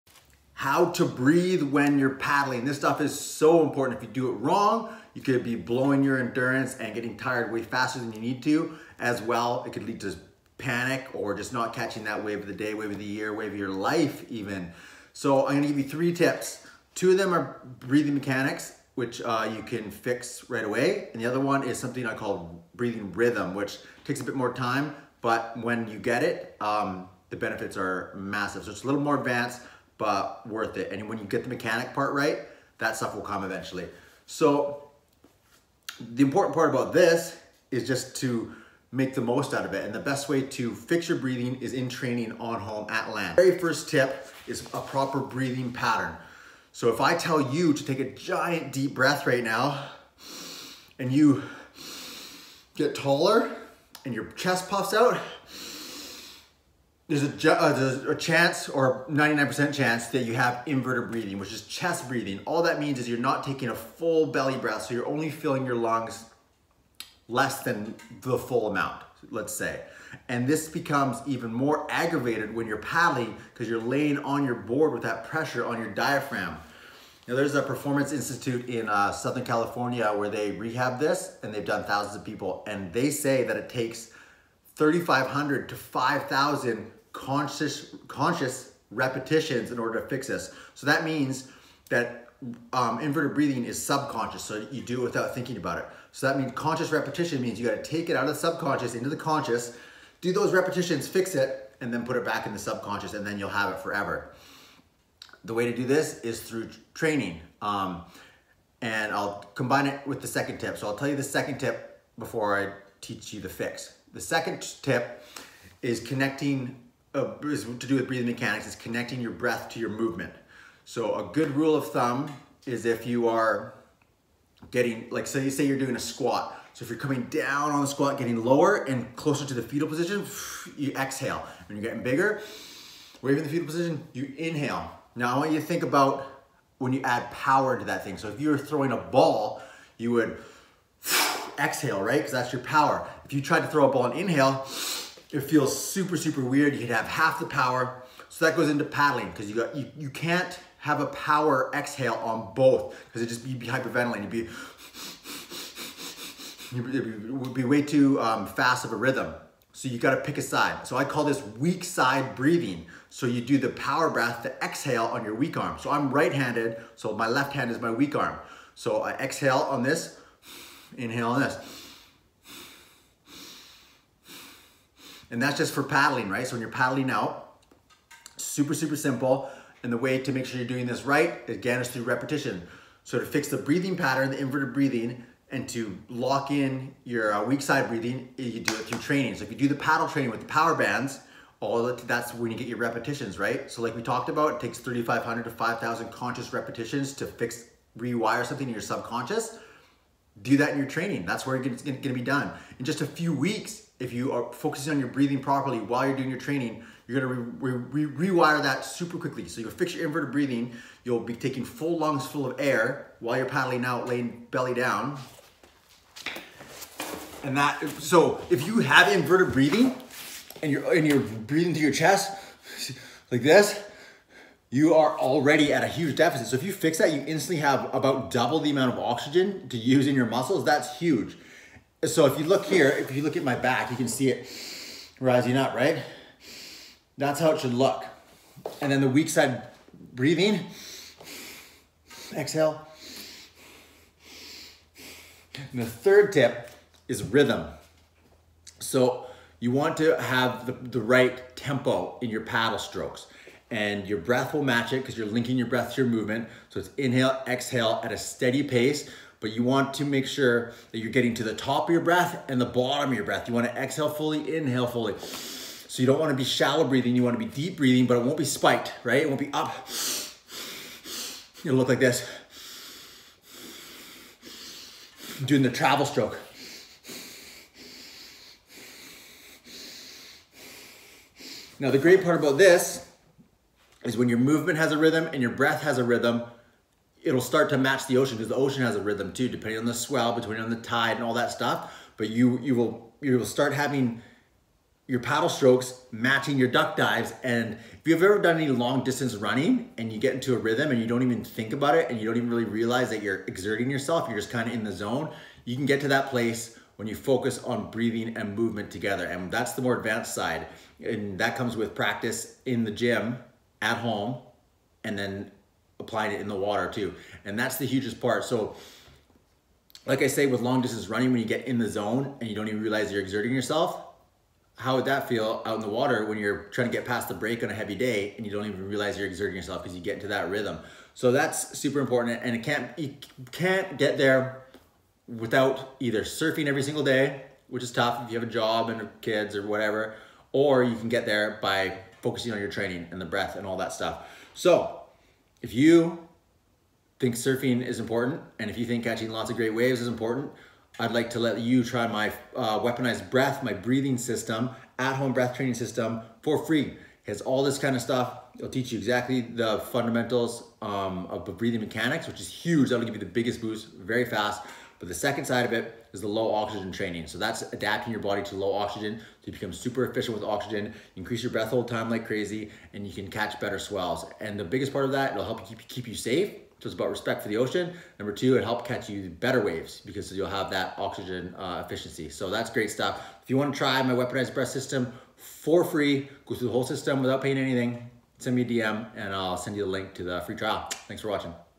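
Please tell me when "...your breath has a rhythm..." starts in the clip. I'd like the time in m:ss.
4:45.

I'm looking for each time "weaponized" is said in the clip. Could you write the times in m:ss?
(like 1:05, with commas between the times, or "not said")
5:52, 6:24.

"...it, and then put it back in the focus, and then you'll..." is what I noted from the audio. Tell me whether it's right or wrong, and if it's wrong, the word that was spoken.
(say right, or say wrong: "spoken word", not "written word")
wrong: "subconscious", not "focus".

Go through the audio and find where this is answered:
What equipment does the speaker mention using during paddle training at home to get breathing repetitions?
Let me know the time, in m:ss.
3:10.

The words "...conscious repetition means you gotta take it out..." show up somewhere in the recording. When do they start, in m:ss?
1:36.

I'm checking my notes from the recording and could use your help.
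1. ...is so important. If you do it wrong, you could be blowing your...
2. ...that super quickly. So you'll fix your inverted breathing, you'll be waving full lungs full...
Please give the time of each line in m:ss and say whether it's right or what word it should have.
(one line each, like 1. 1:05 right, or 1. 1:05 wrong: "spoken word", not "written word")
1. 0:03 right
2. 3:28 wrong: "taking", not "waving".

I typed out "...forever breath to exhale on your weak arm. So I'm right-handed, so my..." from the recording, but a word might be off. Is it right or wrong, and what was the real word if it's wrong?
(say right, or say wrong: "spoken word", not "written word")
wrong: "power", not "forever".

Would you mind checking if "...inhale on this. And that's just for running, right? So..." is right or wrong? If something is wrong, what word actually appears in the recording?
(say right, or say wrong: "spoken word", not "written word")
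wrong: "paddling", not "running".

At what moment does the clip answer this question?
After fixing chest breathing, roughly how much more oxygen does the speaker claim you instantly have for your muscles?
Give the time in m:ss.
3:47.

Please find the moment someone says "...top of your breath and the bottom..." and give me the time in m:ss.
4:21.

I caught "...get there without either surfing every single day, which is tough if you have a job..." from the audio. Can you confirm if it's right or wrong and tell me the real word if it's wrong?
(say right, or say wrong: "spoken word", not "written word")
right.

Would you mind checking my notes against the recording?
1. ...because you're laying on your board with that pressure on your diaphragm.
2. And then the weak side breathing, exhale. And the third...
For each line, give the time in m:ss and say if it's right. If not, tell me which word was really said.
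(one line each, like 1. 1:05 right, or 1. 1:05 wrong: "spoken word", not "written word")
1. 1:13 right
2. 3:58 right.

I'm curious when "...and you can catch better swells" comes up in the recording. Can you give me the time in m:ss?
6:12.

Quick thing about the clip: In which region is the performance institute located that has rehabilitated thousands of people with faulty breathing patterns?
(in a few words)
Southern California.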